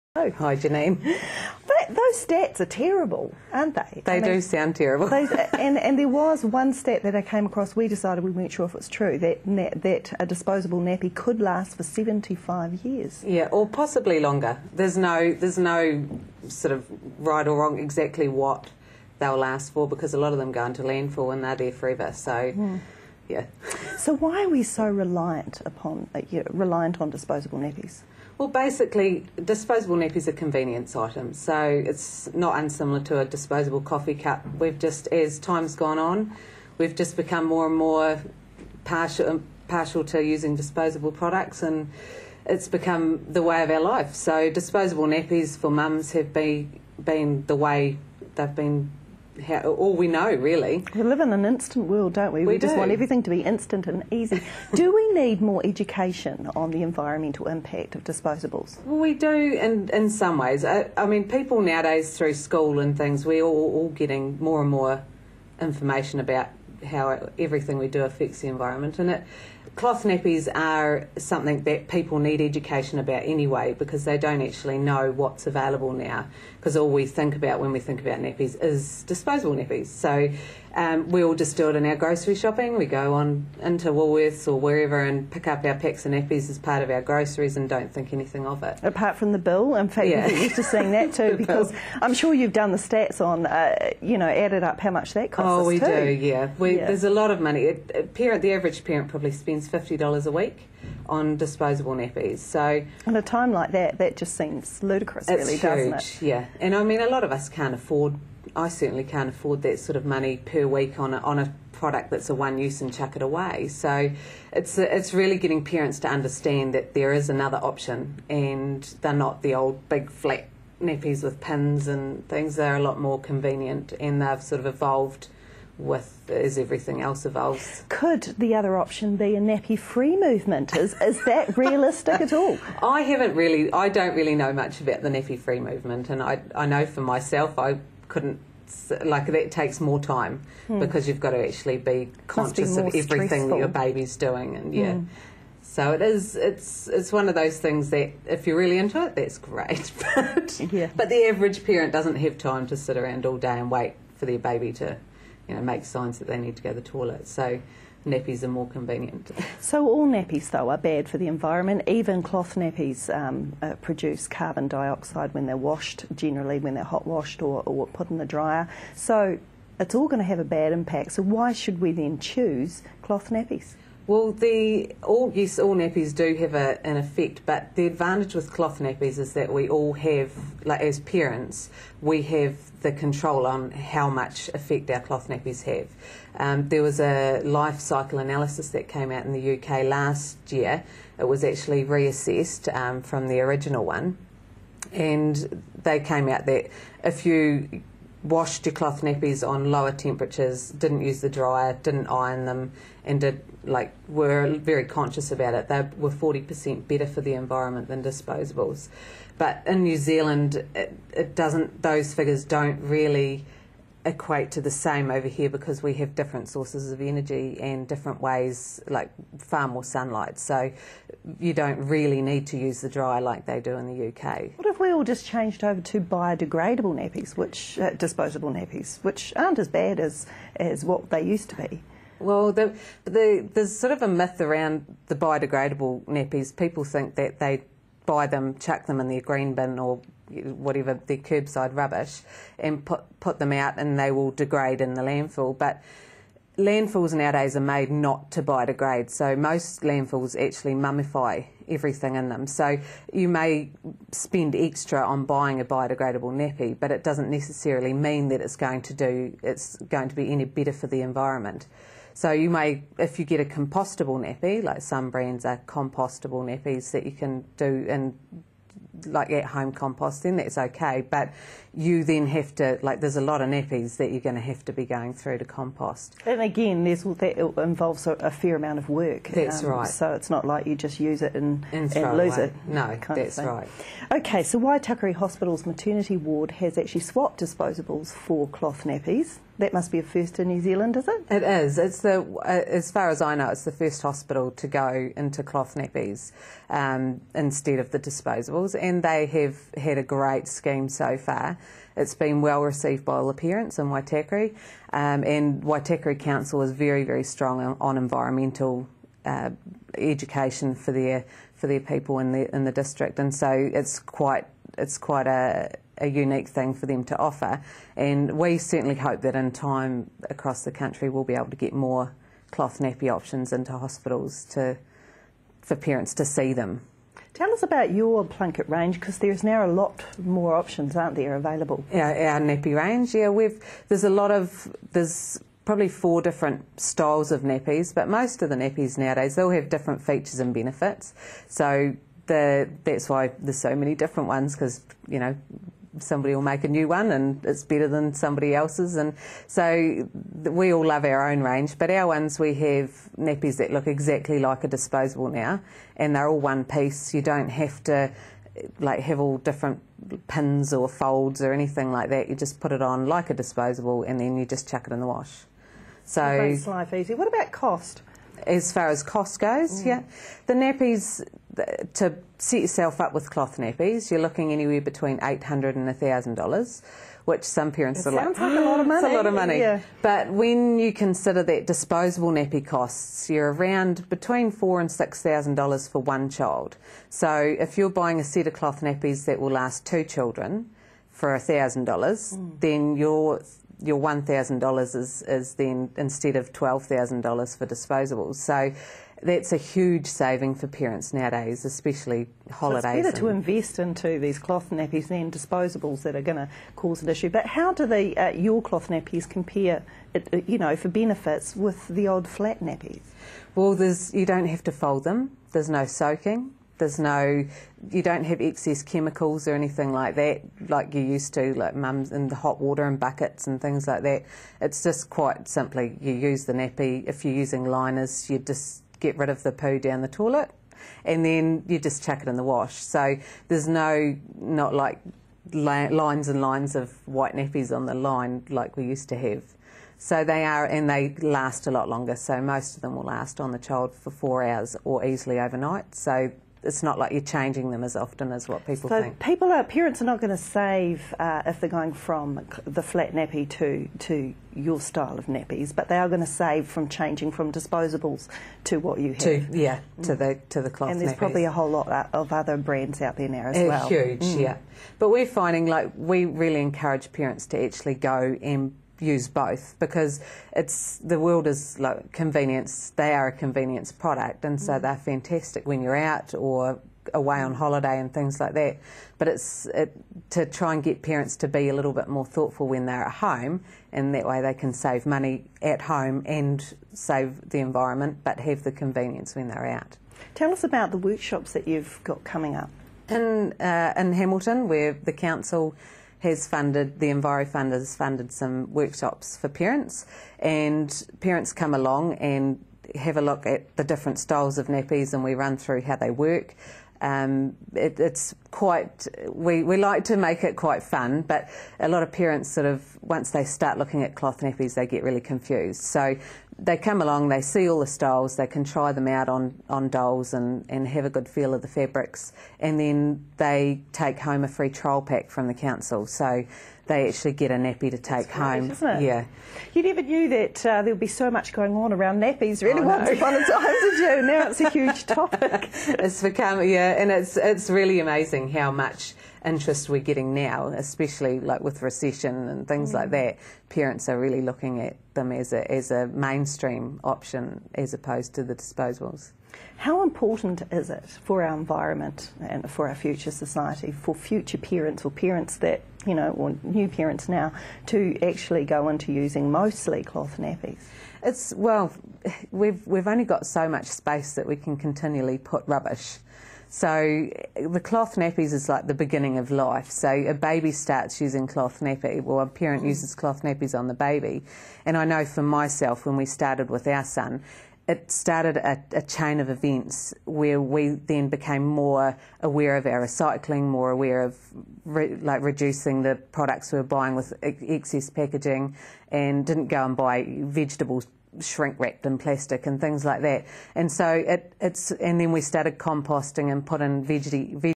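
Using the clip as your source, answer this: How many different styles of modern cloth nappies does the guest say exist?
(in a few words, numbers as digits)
4.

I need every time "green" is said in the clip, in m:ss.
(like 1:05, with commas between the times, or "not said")
3:59.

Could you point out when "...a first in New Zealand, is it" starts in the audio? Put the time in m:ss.
4:49.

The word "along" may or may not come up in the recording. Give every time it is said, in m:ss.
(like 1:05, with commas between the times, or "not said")
8:21, 8:37.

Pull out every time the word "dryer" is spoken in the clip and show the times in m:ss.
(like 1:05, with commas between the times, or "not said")
2:48, 3:21.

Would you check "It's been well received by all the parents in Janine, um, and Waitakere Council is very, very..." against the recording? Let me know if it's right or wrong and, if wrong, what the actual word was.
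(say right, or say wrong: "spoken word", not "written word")
wrong: "Waitakere", not "Janine".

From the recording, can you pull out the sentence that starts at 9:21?
It's, well, we've, we've only got so much space that we can continually put rubbish.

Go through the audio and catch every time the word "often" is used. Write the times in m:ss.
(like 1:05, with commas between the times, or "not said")
7:27.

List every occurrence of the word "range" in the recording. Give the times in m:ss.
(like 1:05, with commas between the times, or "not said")
5:28, 5:32, 5:51.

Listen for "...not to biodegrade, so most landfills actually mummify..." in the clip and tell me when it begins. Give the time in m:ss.
4:07.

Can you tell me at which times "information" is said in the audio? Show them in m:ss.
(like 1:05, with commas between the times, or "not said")
1:05.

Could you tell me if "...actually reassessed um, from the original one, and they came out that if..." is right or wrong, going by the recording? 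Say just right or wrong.
right.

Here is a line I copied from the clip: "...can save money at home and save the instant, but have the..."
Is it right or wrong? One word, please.
wrong.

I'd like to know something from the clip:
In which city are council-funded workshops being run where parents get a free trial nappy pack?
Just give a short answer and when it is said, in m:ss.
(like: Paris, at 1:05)
Hamilton, at 8:14.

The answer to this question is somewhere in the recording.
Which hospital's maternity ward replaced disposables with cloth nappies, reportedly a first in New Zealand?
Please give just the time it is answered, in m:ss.
4:44.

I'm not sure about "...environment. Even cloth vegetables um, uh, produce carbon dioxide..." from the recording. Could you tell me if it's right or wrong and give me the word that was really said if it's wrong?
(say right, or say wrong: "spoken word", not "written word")
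wrong: "nappies", not "vegetables".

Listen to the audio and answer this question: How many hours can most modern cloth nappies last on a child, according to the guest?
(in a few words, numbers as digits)
4.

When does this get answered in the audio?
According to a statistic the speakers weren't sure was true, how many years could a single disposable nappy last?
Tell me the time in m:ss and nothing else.
0:11.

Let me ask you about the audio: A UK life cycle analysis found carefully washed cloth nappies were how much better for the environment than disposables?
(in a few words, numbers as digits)
40 percent.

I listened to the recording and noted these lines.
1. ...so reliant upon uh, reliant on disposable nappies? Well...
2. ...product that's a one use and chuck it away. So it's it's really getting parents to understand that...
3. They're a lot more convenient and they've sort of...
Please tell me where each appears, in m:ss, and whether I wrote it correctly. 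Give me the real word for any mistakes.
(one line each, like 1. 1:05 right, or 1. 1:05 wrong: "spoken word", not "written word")
1. 0:24 right
2. 1:51 right
3. 2:02 right.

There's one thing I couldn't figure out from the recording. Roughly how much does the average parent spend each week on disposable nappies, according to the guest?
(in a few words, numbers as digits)
$50.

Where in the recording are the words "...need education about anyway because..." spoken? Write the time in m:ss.
1:12.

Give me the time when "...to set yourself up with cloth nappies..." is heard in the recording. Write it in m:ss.
6:11.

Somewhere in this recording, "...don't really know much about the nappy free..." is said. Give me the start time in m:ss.
2:13.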